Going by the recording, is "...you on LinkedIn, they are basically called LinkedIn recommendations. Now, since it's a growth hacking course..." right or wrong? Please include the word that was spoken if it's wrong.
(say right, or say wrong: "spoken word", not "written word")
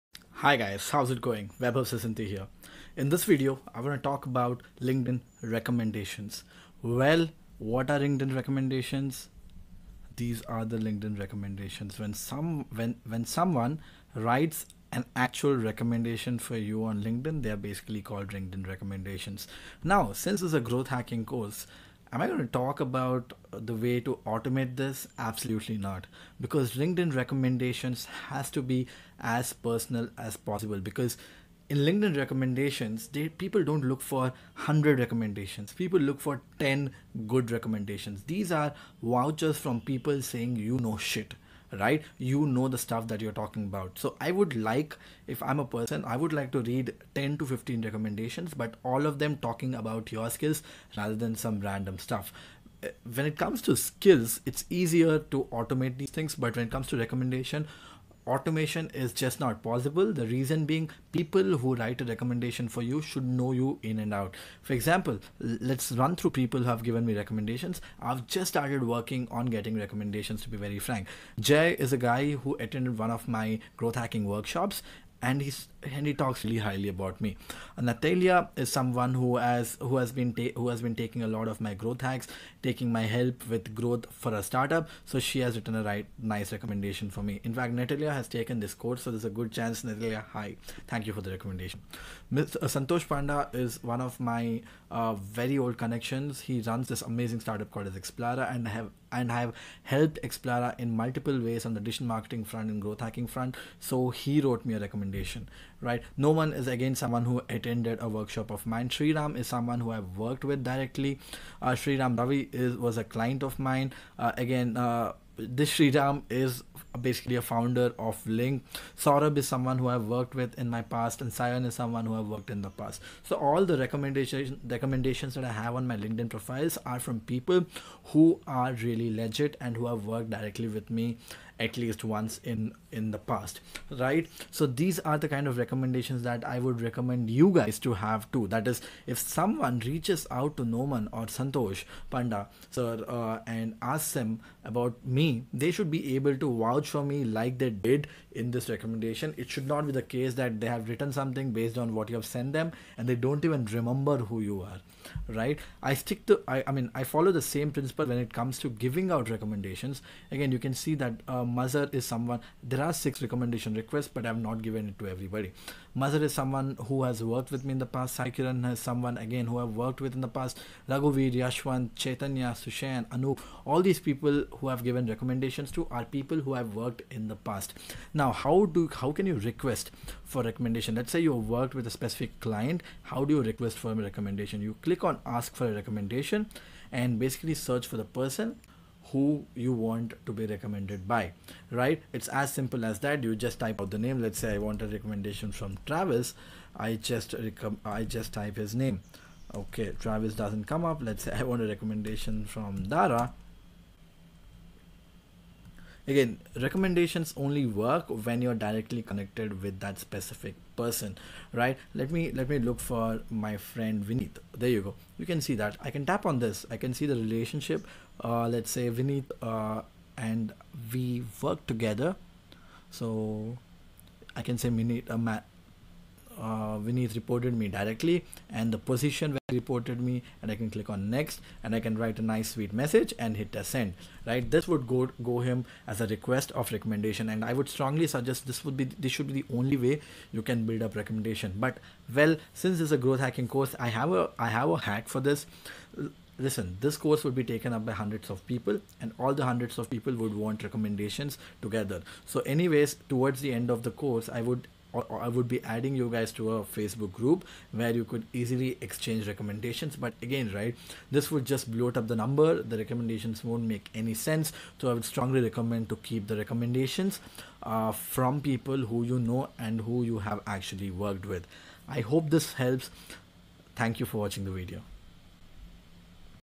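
right.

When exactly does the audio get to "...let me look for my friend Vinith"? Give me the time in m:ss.
3:32.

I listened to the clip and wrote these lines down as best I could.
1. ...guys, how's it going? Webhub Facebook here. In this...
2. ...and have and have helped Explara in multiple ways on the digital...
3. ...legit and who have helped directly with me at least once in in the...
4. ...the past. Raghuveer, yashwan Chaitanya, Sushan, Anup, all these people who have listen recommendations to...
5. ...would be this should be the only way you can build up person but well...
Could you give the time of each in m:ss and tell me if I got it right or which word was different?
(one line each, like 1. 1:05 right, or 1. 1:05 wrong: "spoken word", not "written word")
1. 0:00 wrong: "Sasanti", not "Facebook"
2. 1:38 right
3. 2:09 wrong: "worked", not "helped"
4. 2:50 wrong: "given", not "listen"
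5. 3:58 wrong: "recommendation", not "person".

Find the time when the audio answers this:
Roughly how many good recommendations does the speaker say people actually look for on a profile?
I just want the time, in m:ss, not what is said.
0:36.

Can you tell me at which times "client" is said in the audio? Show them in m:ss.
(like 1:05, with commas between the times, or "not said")
1:53, 3:02.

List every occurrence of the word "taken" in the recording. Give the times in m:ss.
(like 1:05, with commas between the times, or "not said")
1:28, 4:07.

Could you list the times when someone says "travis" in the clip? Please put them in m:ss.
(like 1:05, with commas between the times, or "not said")
3:15, 3:19.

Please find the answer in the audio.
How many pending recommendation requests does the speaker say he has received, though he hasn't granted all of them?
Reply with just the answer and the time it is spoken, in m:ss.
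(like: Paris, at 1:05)
6, at 2:42.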